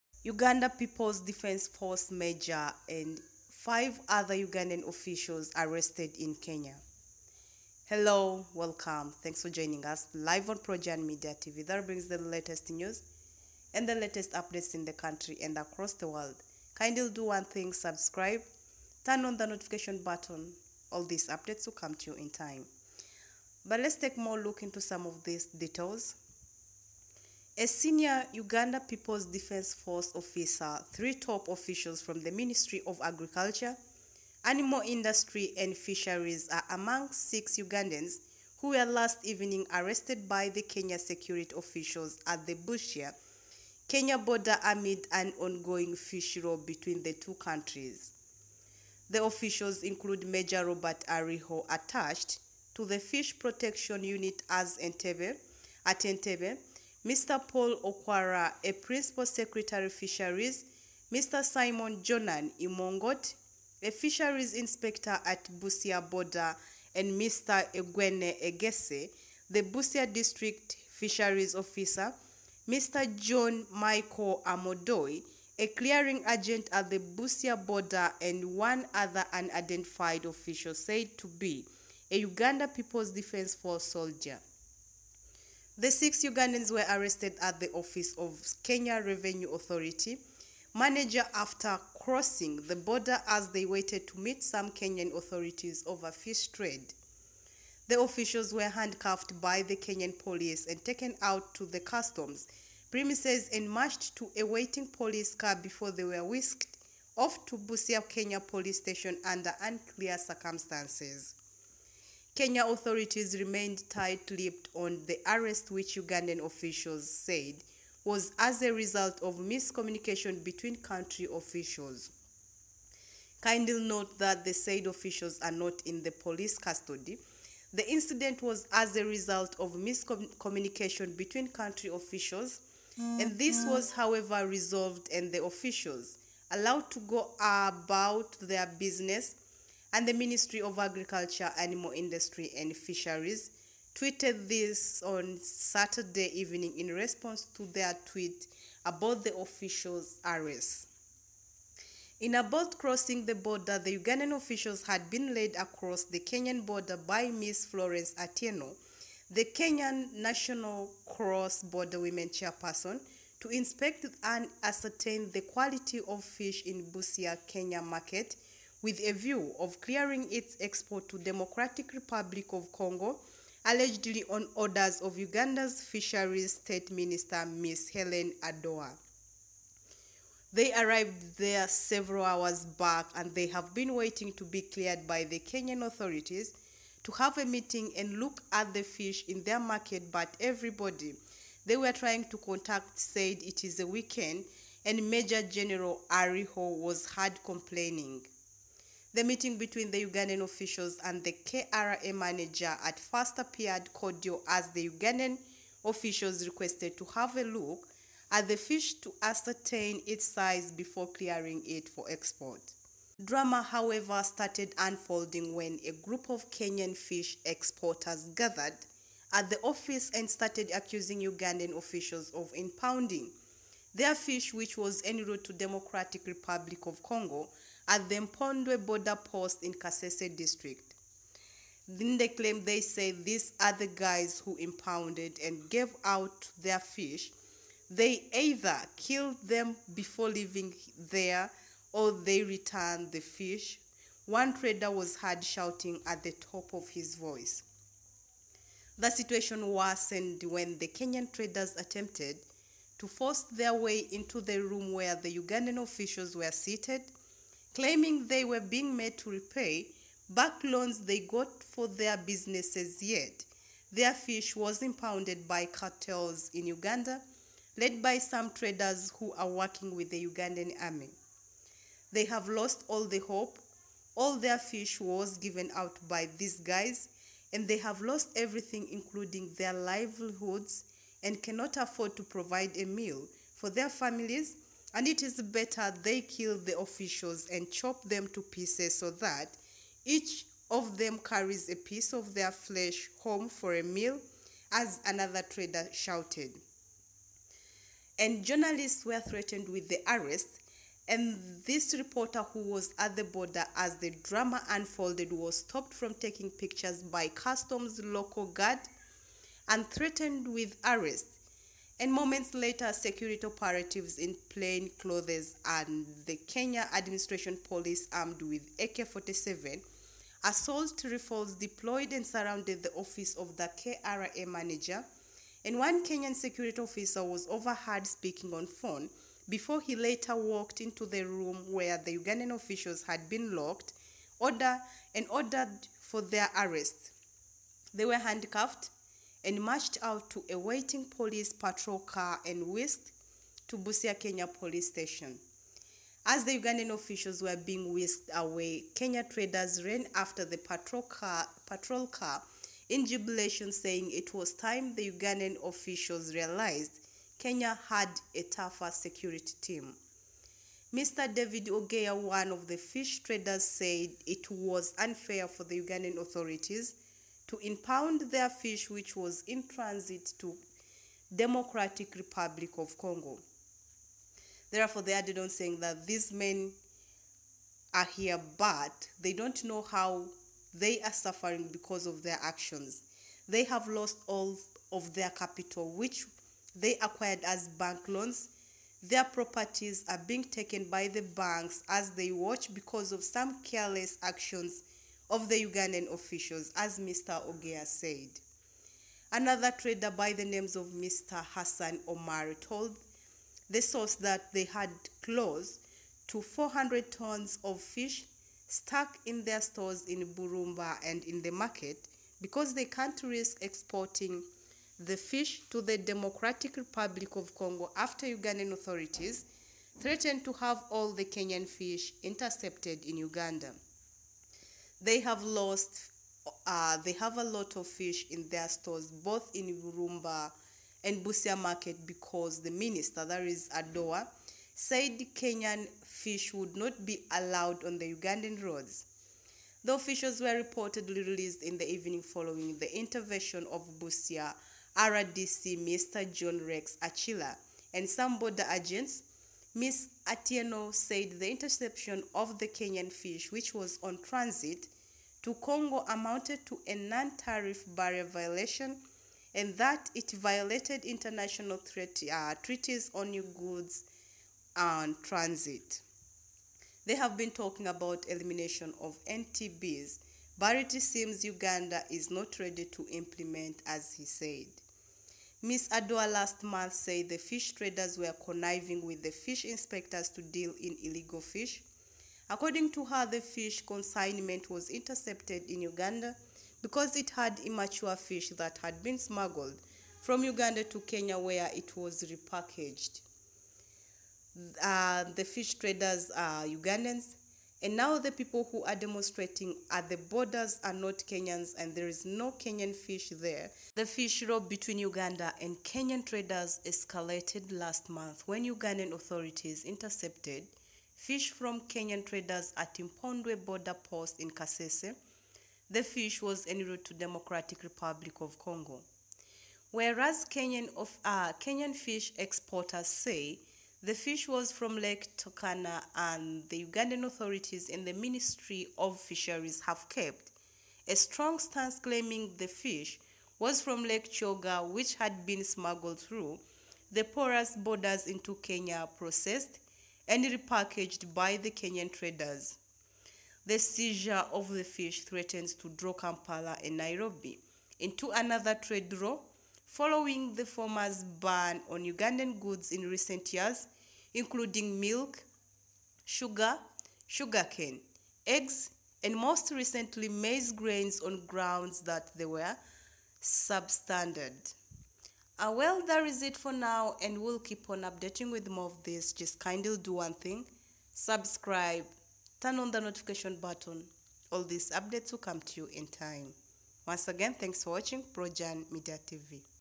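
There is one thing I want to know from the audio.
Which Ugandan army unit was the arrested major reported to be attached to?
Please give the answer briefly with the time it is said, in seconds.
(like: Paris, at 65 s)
Fish Protection Unit, at 52 s.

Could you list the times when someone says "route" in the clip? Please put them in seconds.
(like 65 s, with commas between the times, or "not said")
225 s, 516 s.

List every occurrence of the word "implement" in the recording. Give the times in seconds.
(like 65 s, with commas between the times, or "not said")
473 s.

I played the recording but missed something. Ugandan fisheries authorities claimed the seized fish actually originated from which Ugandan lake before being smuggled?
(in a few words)
Lake Kyoga.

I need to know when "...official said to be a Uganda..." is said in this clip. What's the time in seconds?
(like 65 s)
80 s.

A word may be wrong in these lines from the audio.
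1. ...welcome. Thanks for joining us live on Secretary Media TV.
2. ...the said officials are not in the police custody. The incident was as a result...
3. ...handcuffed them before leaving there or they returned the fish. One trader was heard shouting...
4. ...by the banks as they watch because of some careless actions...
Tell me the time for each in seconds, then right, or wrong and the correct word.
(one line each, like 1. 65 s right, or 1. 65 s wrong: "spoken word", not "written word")
1. 8 s wrong: "Projourn", not "Secretary"
2. 124 s right
3. 238 s wrong: "killed", not "handcuffed"
4. 390 s right.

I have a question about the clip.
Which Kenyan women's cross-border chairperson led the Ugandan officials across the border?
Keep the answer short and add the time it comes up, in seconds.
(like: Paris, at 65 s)
Florence Atieno, at 157 s.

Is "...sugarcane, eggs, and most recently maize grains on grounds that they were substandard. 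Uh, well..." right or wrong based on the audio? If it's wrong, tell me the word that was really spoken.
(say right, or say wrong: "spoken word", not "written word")
right.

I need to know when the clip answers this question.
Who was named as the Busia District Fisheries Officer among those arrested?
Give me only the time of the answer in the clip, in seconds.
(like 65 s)
67 s.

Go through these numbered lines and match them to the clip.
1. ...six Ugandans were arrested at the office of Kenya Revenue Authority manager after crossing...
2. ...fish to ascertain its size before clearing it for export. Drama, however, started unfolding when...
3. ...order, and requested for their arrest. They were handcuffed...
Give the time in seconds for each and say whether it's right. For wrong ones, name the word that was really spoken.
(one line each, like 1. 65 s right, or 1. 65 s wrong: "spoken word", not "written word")
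1. 85 s right
2. 208 s right
3. 334 s wrong: "ordered", not "requested".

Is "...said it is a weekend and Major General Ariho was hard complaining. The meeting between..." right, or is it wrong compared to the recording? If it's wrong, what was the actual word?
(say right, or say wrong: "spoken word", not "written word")
right.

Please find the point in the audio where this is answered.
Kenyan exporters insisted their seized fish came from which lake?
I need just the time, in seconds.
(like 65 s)
524 s.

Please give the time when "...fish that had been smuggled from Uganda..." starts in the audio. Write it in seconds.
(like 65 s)
488 s.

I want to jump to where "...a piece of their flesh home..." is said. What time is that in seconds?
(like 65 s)
291 s.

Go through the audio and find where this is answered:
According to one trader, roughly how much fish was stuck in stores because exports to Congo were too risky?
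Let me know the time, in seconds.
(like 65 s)
406 s.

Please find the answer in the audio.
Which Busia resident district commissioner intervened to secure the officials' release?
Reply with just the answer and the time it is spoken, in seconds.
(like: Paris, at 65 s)
John Rex Achila, at 446 s.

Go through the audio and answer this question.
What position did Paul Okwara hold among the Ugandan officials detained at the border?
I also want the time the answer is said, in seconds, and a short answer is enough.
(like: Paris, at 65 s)
Principal Secretary Fisheries, at 58 s.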